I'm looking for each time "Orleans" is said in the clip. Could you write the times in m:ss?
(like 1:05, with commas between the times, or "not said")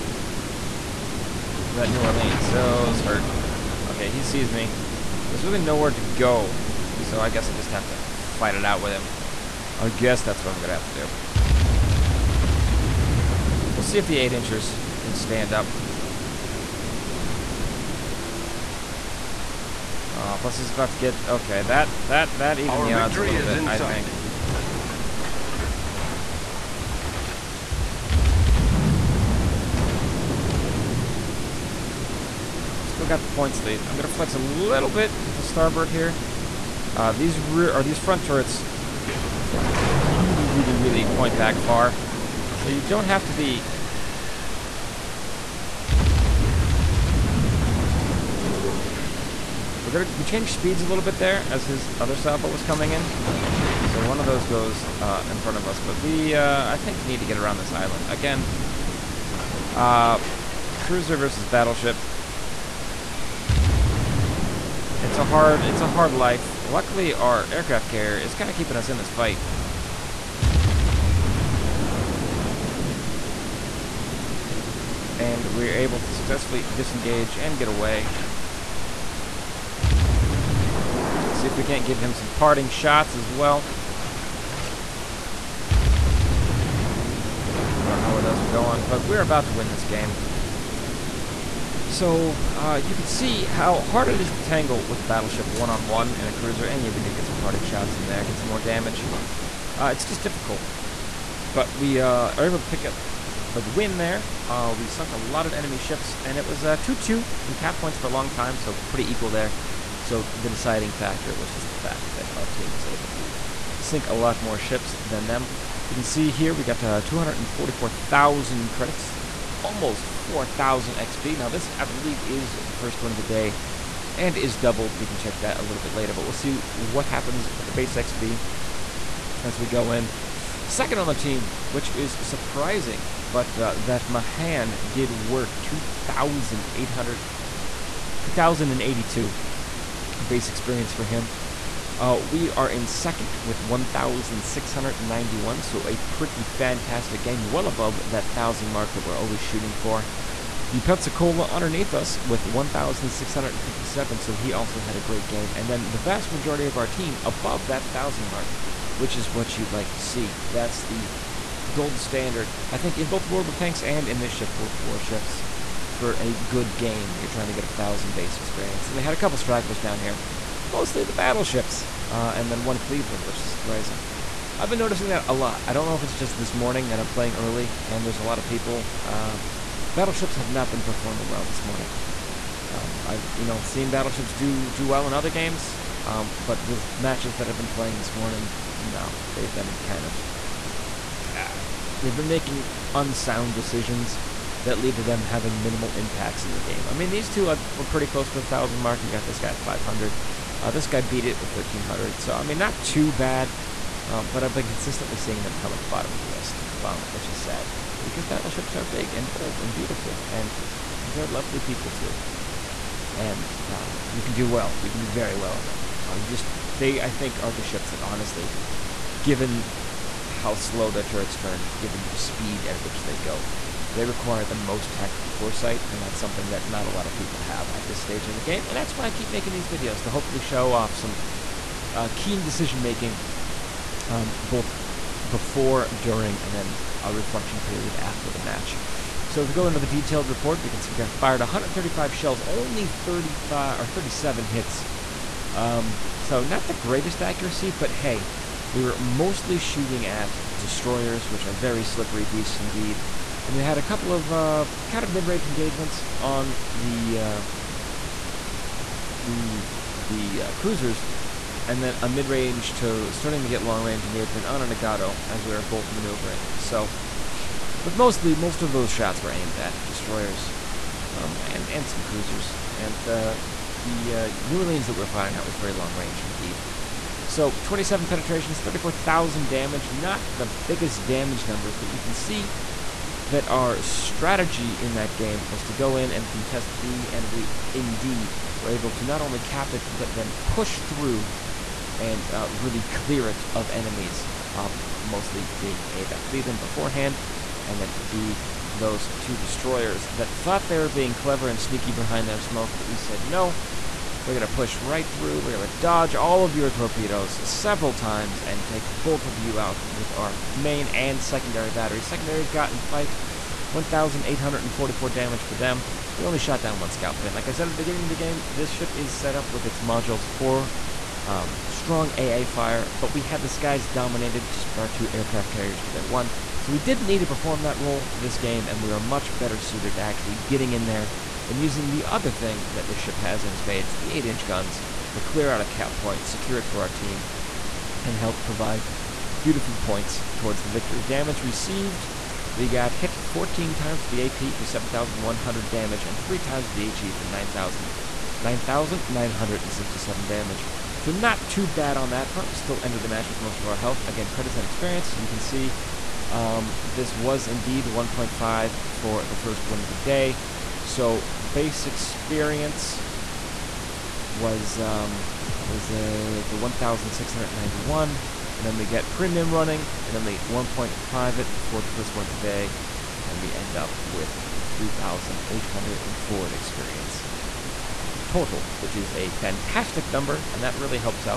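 0:02, 4:34.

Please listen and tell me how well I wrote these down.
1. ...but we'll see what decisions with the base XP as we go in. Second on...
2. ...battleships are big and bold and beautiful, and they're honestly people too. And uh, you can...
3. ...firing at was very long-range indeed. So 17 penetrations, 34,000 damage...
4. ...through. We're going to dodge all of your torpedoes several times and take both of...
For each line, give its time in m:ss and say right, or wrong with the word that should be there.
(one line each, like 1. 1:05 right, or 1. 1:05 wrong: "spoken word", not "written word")
1. 2:06 wrong: "happens", not "decisions"
2. 3:28 wrong: "lovely", not "honestly"
3. 4:35 wrong: "27", not "17"
4. 5:05 right.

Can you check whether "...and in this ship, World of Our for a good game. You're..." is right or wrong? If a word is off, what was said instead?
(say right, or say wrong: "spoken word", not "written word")
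wrong: "Warships", not "Our".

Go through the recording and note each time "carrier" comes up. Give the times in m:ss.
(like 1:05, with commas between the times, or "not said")
1:07, 5:25.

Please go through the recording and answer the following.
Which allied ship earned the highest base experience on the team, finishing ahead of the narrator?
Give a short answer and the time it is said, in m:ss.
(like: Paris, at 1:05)
Mahan, at 2:14.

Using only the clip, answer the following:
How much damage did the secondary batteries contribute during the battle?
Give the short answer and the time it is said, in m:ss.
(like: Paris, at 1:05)
1,844, at 5:13.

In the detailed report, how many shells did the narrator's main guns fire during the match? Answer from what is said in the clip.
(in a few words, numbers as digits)
135.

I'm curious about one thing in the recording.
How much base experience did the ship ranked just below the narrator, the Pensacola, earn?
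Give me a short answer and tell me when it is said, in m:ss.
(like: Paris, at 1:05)
1,657, at 2:32.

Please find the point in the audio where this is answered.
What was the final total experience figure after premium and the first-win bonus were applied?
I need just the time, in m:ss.
6:14.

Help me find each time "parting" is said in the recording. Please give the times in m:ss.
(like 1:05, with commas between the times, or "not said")
1:22, 1:37.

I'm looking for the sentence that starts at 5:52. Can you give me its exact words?
We still ended the match with most of our health.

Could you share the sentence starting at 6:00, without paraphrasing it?
So base experience was um, was uh, the 1,691.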